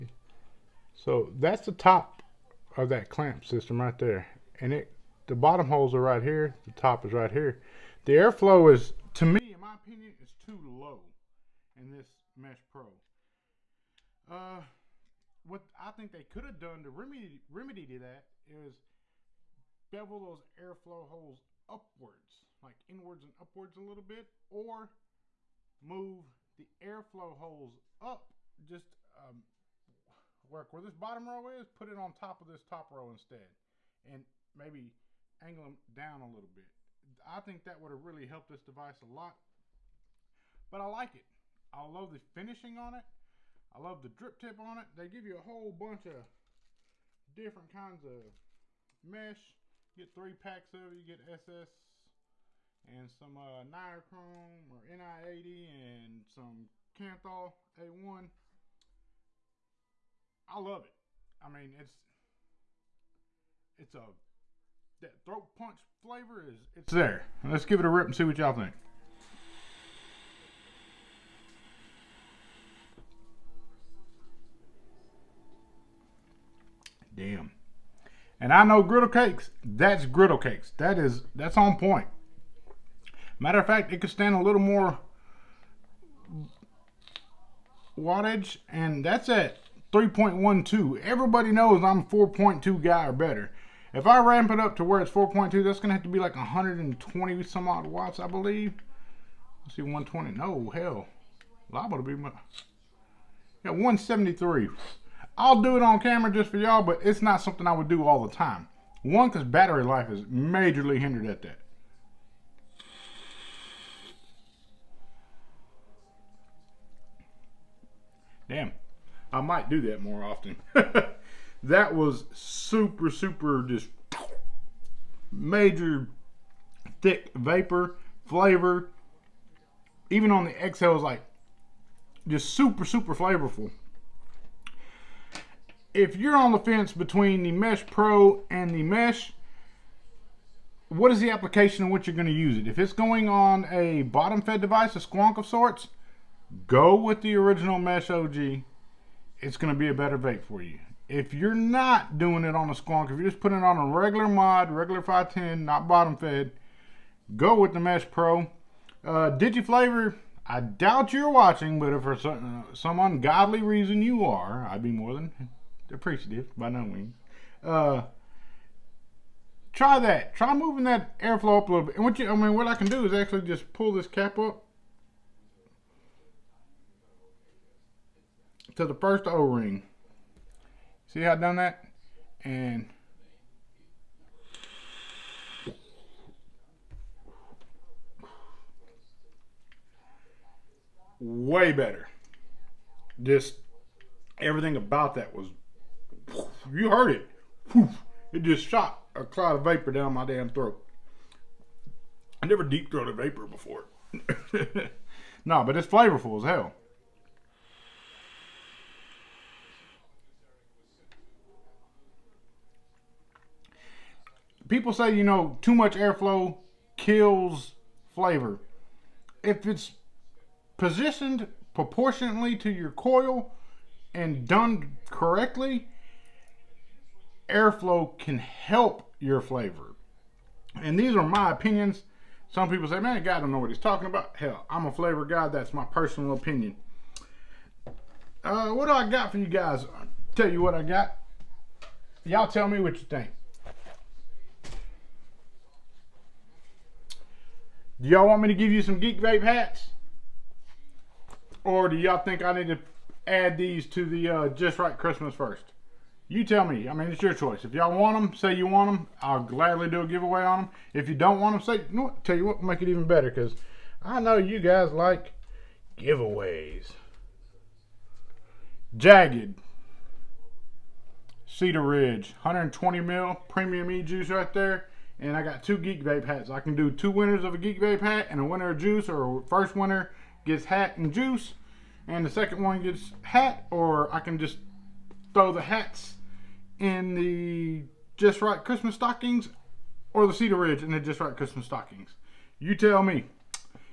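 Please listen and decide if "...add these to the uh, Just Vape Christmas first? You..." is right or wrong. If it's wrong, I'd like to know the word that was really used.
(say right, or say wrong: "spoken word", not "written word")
wrong: "Right", not "Vape".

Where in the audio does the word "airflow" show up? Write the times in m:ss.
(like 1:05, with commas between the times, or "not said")
0:08, 0:20, 0:26, 2:51, 3:35, 3:47.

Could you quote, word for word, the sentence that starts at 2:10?
Even on the exhale it's like just super, super flavorful.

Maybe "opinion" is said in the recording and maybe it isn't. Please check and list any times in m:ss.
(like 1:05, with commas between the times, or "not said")
0:09, 3:51, 3:56.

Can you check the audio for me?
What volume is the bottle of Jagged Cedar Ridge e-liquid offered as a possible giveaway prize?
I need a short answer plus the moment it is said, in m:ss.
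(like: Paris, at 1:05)
120 ml, at 4:32.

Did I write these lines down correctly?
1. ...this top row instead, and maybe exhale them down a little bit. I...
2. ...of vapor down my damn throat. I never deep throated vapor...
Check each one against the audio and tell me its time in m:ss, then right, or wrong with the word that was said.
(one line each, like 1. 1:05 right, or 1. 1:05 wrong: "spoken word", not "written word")
1. 0:32 wrong: "angle", not "exhale"
2. 3:19 right.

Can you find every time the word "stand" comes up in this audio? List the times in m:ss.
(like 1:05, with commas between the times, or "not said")
1:24.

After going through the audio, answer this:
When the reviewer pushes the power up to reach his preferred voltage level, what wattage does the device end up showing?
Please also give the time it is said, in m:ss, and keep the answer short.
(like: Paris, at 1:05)
173, at 1:43.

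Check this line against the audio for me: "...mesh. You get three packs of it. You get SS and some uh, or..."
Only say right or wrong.
right.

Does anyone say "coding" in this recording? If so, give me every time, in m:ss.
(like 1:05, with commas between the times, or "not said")
not said.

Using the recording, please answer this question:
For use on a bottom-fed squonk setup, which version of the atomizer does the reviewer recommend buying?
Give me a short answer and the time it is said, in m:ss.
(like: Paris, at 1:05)
Mesh OG, at 2:27.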